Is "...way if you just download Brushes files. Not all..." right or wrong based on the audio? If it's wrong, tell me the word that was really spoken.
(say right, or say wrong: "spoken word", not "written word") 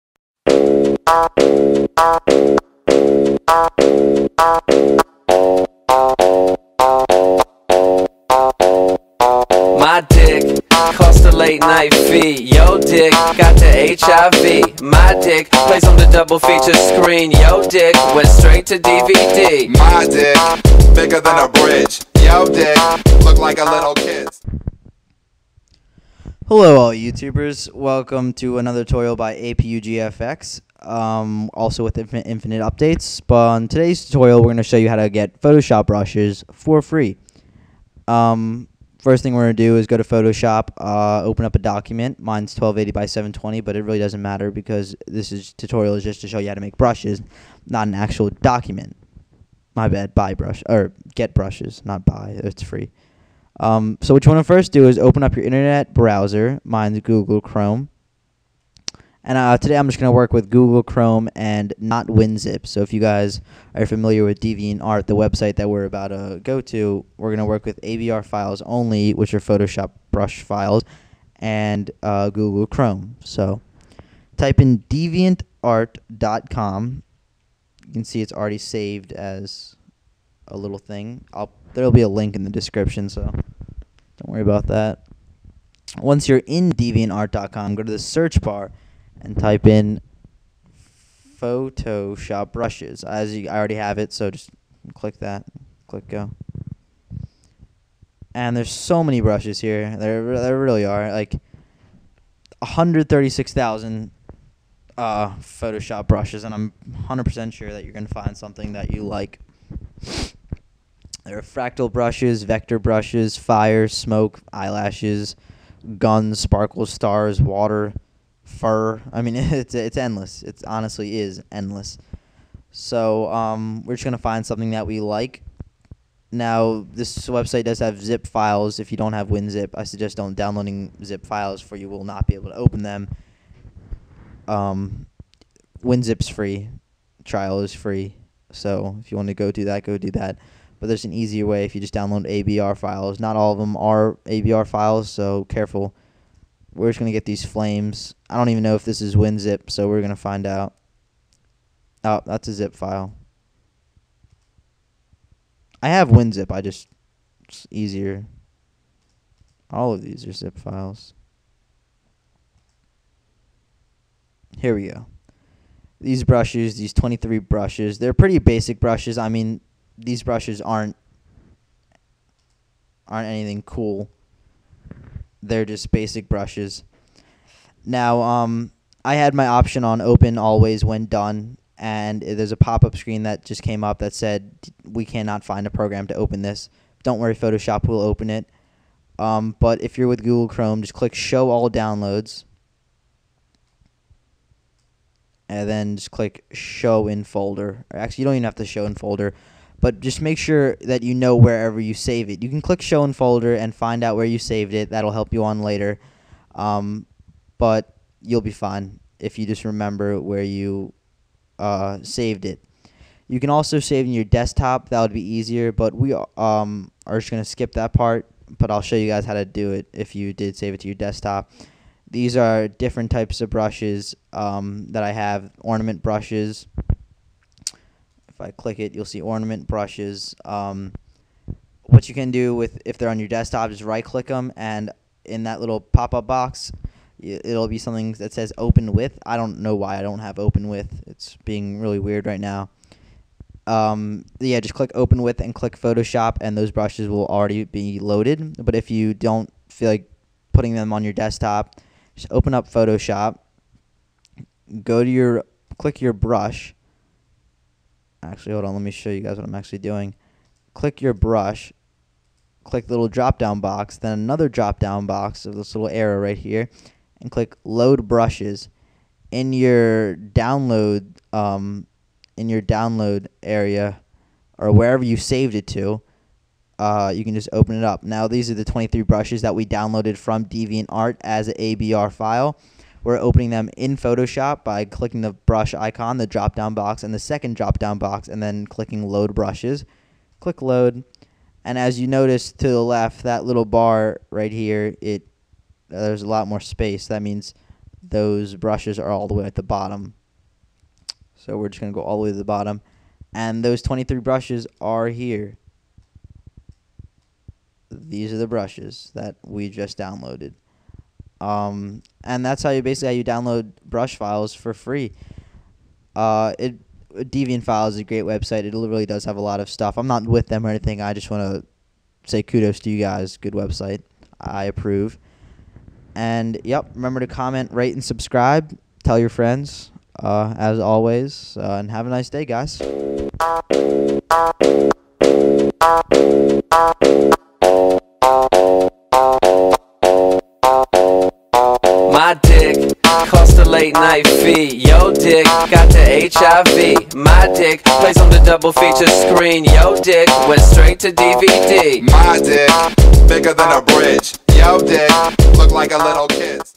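wrong: "ABR", not "Brushes".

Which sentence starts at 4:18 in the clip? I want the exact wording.
Let me show you guys what I'm actually doing.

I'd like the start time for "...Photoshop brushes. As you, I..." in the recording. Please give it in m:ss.
1:31.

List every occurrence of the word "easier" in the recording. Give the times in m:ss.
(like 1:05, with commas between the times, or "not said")
2:21, 2:37, 3:35.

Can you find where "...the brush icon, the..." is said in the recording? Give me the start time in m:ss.
4:45.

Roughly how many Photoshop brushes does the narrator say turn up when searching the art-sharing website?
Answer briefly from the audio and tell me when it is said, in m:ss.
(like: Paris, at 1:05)
136,000, at 1:42.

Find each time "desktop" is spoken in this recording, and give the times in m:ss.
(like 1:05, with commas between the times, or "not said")
3:34, 3:40, 3:53, 4:11.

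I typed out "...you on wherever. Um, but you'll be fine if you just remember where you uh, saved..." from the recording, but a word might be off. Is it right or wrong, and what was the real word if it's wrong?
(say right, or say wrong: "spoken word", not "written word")
wrong: "later", not "wherever".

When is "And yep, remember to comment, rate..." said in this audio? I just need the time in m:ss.
5:26.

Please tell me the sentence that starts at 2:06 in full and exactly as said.
Now this website does have zip files.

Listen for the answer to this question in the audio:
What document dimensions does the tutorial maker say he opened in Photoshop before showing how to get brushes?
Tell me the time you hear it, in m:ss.
0:42.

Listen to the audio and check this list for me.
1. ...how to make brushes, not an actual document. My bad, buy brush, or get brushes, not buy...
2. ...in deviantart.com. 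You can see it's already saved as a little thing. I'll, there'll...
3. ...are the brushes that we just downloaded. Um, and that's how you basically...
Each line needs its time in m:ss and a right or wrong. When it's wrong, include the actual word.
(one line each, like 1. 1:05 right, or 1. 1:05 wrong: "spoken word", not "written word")
1. 0:46 right
2. 1:14 right
3. 5:08 right.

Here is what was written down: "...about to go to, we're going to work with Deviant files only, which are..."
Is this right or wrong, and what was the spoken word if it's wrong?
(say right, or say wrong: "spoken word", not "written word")
wrong: "ABR", not "Deviant".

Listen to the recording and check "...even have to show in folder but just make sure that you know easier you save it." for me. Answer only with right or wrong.
wrong.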